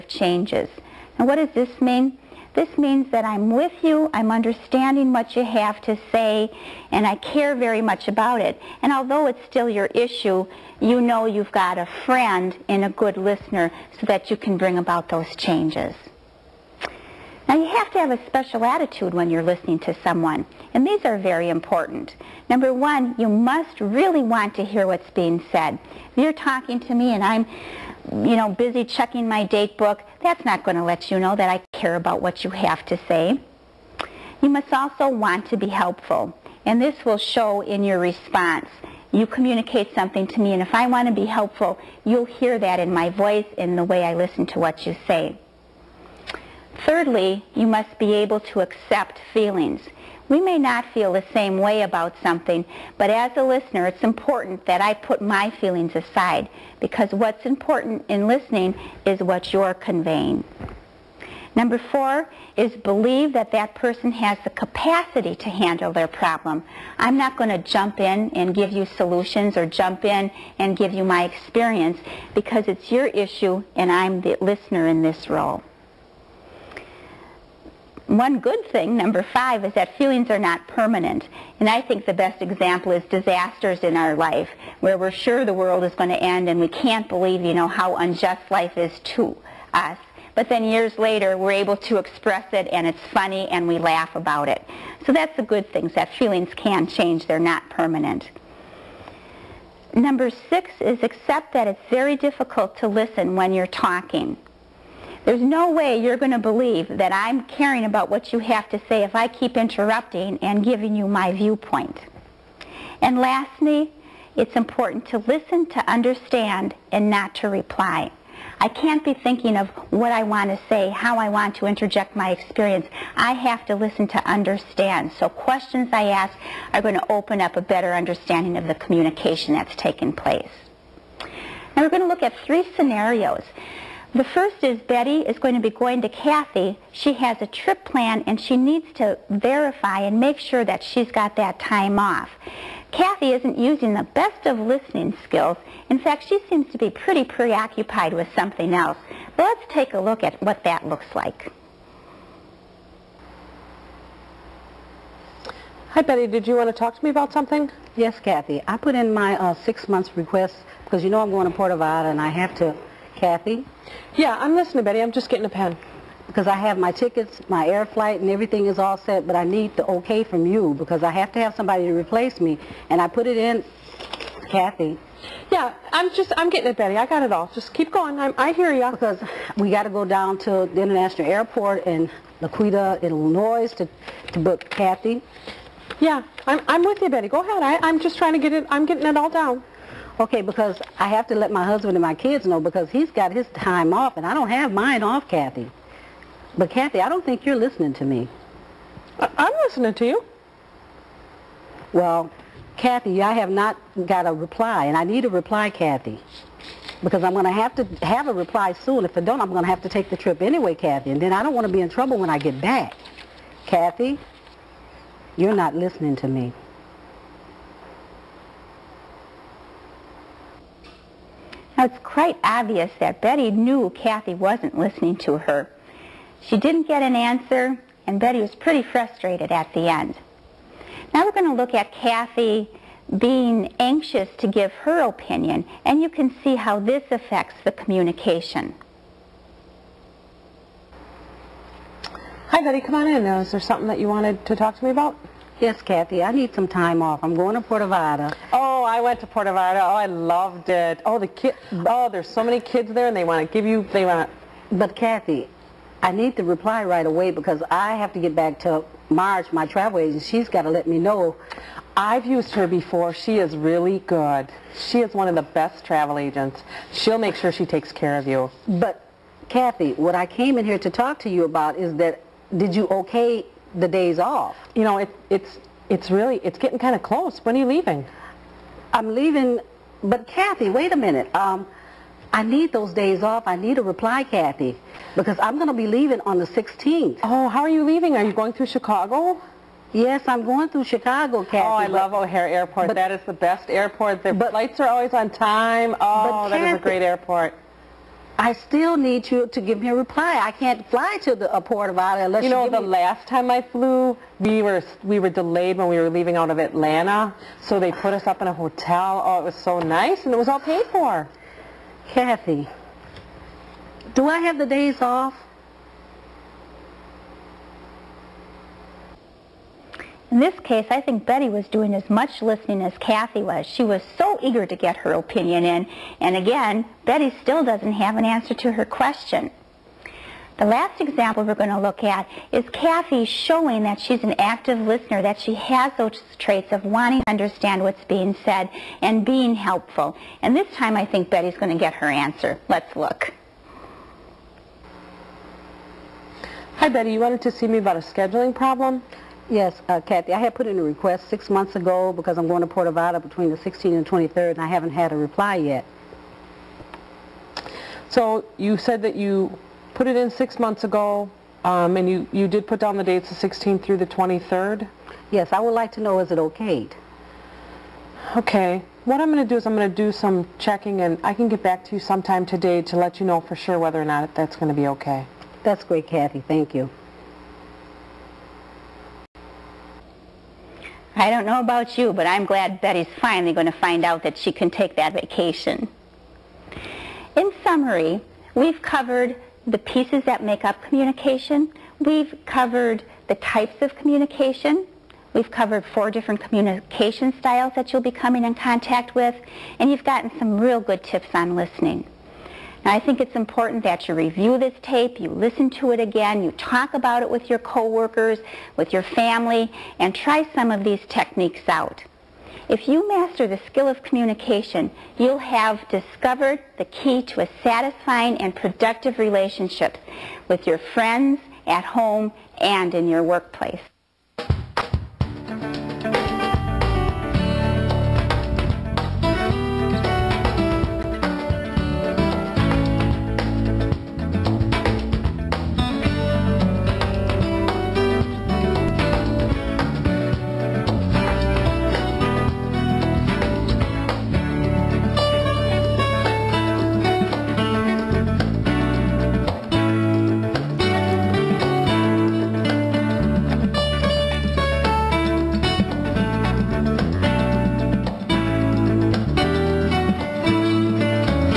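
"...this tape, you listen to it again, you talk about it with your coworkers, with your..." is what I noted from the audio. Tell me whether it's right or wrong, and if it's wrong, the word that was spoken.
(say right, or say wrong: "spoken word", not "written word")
right.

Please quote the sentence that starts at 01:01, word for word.
Number four is believe that that person has the capacity to handle their problem.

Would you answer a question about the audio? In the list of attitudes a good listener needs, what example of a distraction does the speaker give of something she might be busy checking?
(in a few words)
Date book.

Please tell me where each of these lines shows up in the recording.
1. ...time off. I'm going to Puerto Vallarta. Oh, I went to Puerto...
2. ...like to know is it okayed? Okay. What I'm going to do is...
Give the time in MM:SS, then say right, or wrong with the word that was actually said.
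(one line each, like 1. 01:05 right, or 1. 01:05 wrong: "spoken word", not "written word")
1. 04:06 right
2. 06:05 right.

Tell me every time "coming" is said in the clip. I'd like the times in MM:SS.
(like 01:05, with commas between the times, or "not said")
06:38.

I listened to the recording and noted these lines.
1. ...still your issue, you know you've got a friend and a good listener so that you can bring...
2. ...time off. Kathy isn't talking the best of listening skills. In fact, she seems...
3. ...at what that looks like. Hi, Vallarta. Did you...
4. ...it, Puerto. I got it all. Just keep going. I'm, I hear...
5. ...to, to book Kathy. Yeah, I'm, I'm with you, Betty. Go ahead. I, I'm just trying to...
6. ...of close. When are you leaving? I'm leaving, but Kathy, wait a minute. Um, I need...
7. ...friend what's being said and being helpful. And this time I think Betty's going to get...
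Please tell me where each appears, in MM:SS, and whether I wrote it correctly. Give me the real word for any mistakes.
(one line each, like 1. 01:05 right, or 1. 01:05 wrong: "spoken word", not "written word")
1. 00:09 right
2. 02:21 wrong: "using", not "talking"
3. 02:30 wrong: "Betty", not "Vallarta"
4. 02:56 wrong: "Betty", not "Puerto"
5. 03:03 right
6. 04:36 right
7. 05:37 wrong: "understand", not "friend".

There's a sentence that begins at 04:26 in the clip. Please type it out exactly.
She'll make sure she takes care of you.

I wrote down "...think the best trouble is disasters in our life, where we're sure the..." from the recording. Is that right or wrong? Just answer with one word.
wrong.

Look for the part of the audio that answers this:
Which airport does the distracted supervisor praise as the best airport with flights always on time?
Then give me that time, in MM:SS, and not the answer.
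04:52.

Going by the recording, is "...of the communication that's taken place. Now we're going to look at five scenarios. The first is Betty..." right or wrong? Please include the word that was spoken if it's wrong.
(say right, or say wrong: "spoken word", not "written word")
wrong: "three", not "five".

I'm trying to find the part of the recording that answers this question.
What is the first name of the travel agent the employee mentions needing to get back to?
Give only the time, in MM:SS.
04:19.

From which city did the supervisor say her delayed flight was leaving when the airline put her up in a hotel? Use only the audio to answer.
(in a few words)
Atlanta.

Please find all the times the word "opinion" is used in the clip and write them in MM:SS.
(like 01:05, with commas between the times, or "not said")
03:55, 05:25.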